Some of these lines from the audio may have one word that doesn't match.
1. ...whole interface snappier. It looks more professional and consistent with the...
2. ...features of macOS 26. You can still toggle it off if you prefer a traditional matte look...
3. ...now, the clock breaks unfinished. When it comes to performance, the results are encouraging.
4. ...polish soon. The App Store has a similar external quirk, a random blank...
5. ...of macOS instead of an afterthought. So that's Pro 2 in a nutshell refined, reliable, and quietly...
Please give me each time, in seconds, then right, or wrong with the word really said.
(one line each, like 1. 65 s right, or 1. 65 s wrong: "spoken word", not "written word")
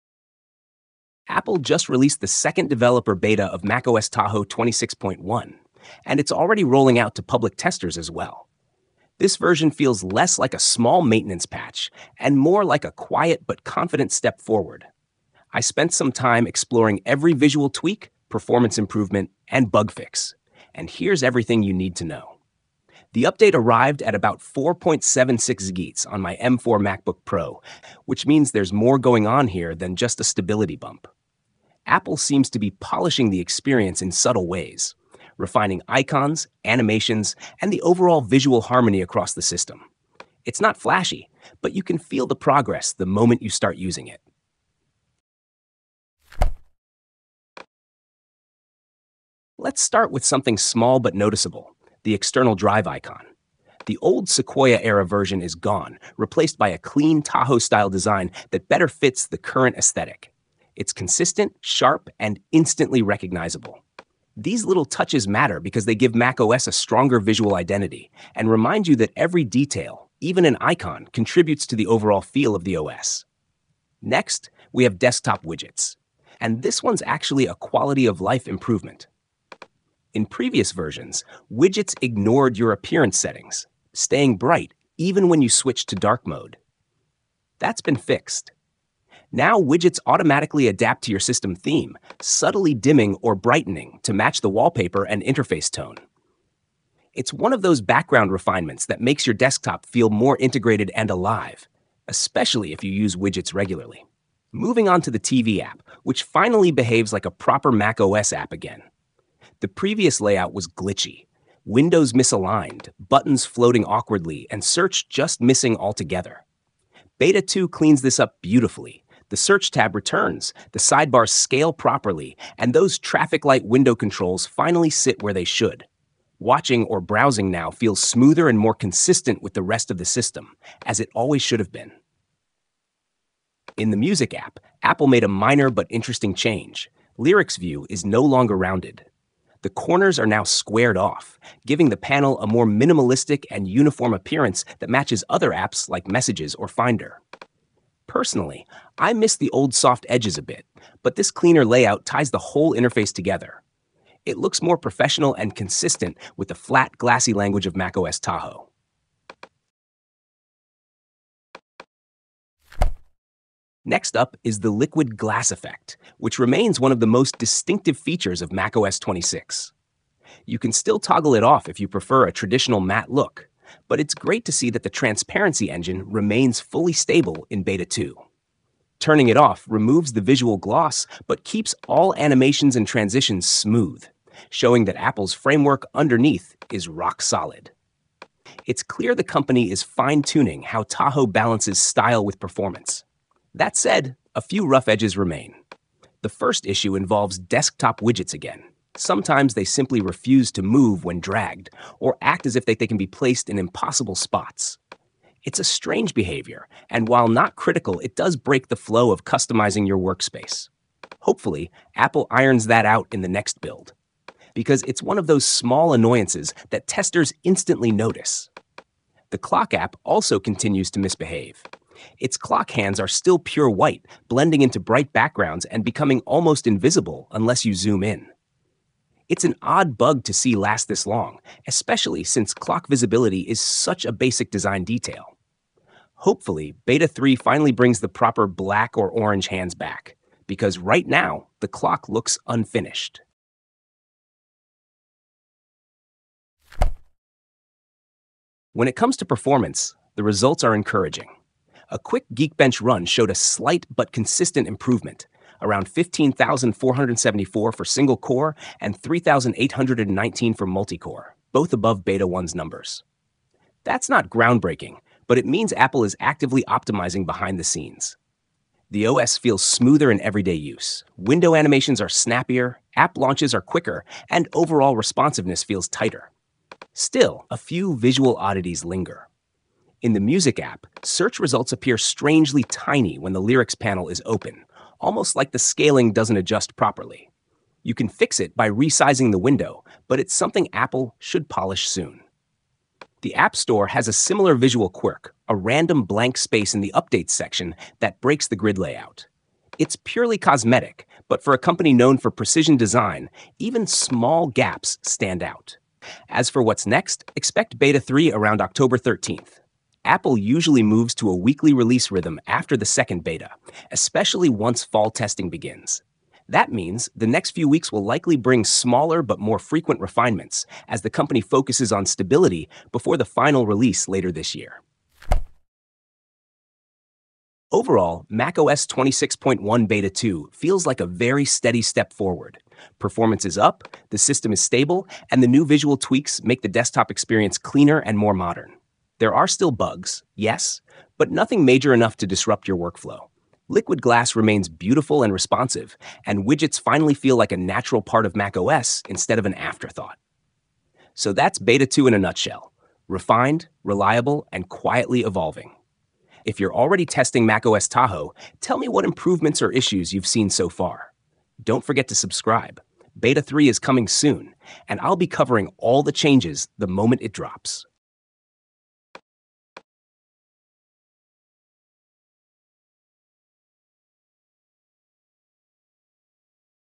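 1. 152 s wrong: "together", not "snappier"
2. 167 s right
3. 241 s wrong: "looks", not "breaks"
4. 291 s wrong: "visual", not "external"
5. 348 s wrong: "Beta", not "Pro".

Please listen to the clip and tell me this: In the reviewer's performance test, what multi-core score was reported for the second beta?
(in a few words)
3,819.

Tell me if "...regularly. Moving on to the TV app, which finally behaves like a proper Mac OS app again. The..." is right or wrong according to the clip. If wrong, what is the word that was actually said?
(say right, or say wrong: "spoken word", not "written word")
right.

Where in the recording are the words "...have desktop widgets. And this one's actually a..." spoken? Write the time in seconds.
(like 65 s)
74 s.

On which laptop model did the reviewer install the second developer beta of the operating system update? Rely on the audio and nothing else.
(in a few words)
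M4 MacBook Pro.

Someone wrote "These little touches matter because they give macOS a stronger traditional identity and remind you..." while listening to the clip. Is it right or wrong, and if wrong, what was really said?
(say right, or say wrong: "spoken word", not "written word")
wrong: "visual", not "traditional".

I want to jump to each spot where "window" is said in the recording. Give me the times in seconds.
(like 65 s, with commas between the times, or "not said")
111 s, 123 s, 271 s, 289 s.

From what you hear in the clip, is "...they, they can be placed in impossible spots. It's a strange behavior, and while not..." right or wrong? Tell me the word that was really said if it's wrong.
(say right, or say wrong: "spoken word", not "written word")
right.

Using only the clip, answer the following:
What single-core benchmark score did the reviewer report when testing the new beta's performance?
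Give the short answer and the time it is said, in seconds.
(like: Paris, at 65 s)
15,474, at 255 s.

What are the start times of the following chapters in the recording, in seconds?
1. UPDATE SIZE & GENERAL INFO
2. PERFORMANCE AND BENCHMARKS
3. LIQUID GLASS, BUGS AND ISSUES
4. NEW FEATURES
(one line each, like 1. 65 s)
1. 15 s
2. 246 s
3. 162 s
4. 46 s.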